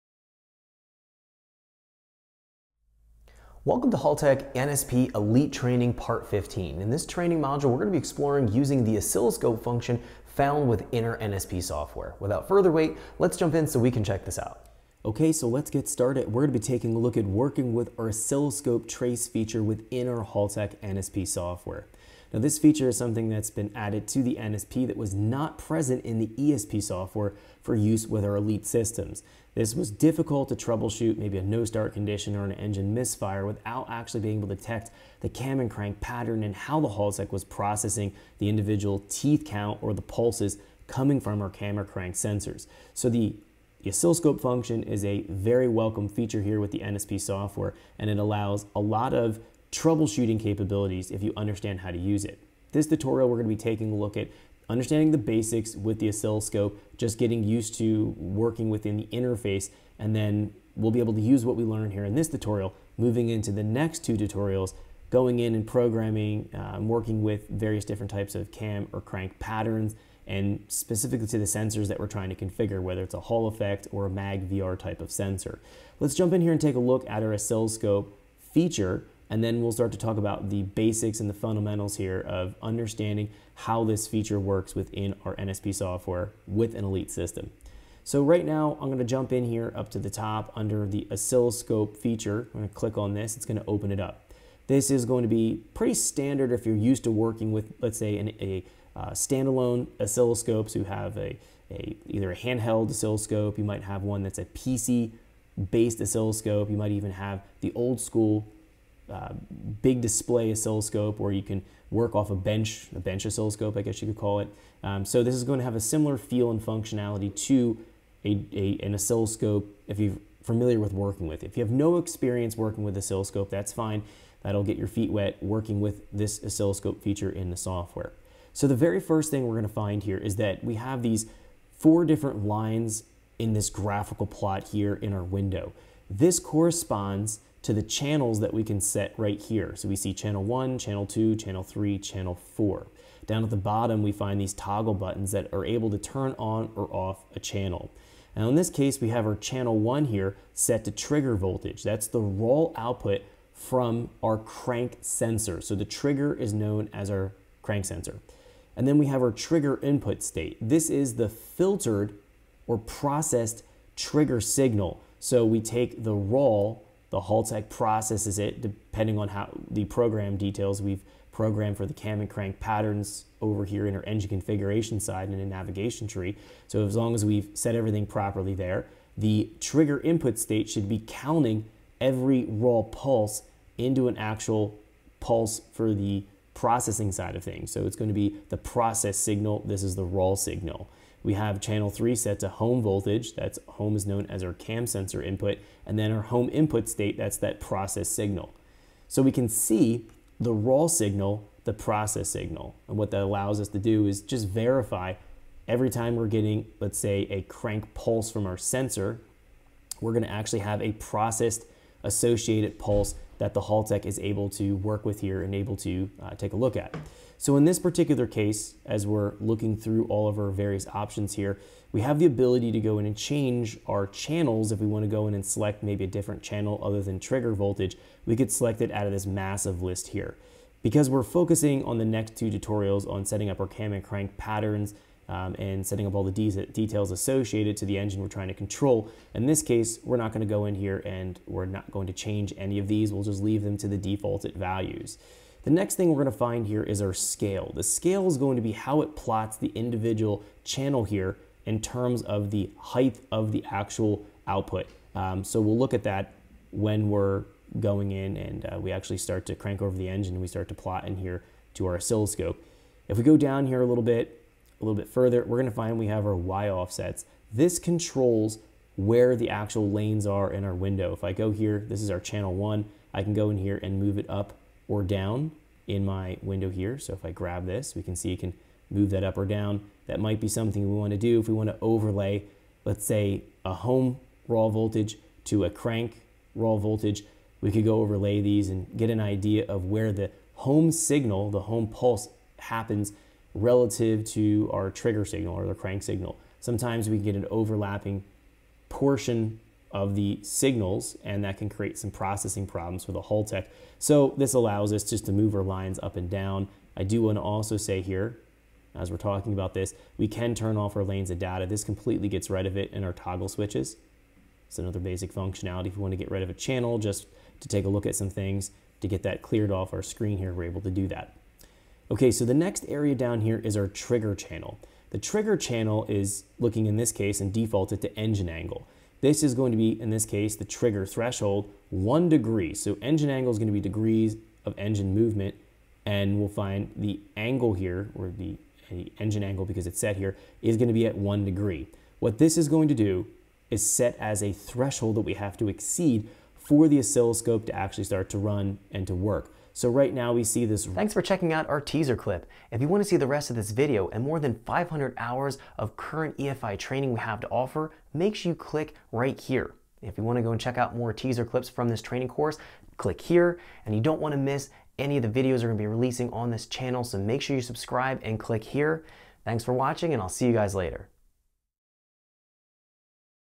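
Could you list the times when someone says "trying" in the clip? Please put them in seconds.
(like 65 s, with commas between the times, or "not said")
72 s, 238 s.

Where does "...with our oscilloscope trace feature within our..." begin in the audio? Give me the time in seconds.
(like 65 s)
17 s.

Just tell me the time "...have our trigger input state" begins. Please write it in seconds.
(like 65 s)
159 s.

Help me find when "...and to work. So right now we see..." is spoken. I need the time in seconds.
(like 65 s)
348 s.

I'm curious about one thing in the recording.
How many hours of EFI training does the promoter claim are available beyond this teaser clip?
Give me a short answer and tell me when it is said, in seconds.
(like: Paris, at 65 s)
500, at 354 s.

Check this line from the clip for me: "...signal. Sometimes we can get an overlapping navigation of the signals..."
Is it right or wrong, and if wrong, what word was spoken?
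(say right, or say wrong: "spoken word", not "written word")
wrong: "portion", not "navigation".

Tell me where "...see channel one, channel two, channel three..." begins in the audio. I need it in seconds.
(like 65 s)
139 s.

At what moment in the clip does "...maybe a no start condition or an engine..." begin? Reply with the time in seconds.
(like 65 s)
31 s.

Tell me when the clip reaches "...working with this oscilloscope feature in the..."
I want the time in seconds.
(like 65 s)
125 s.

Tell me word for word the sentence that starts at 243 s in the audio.
We'll just leave them to the defaulted values.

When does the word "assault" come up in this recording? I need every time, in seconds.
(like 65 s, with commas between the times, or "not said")
not said.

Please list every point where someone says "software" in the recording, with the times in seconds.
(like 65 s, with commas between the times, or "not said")
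11 s, 21 s, 26 s, 47 s, 85 s, 127 s.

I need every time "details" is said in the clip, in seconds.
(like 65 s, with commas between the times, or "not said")
170 s, 236 s.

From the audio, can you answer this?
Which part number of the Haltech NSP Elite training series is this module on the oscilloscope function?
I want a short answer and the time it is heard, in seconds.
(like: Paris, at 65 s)
Part 15, at 5 s.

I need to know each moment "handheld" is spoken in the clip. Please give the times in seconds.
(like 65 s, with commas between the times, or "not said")
102 s.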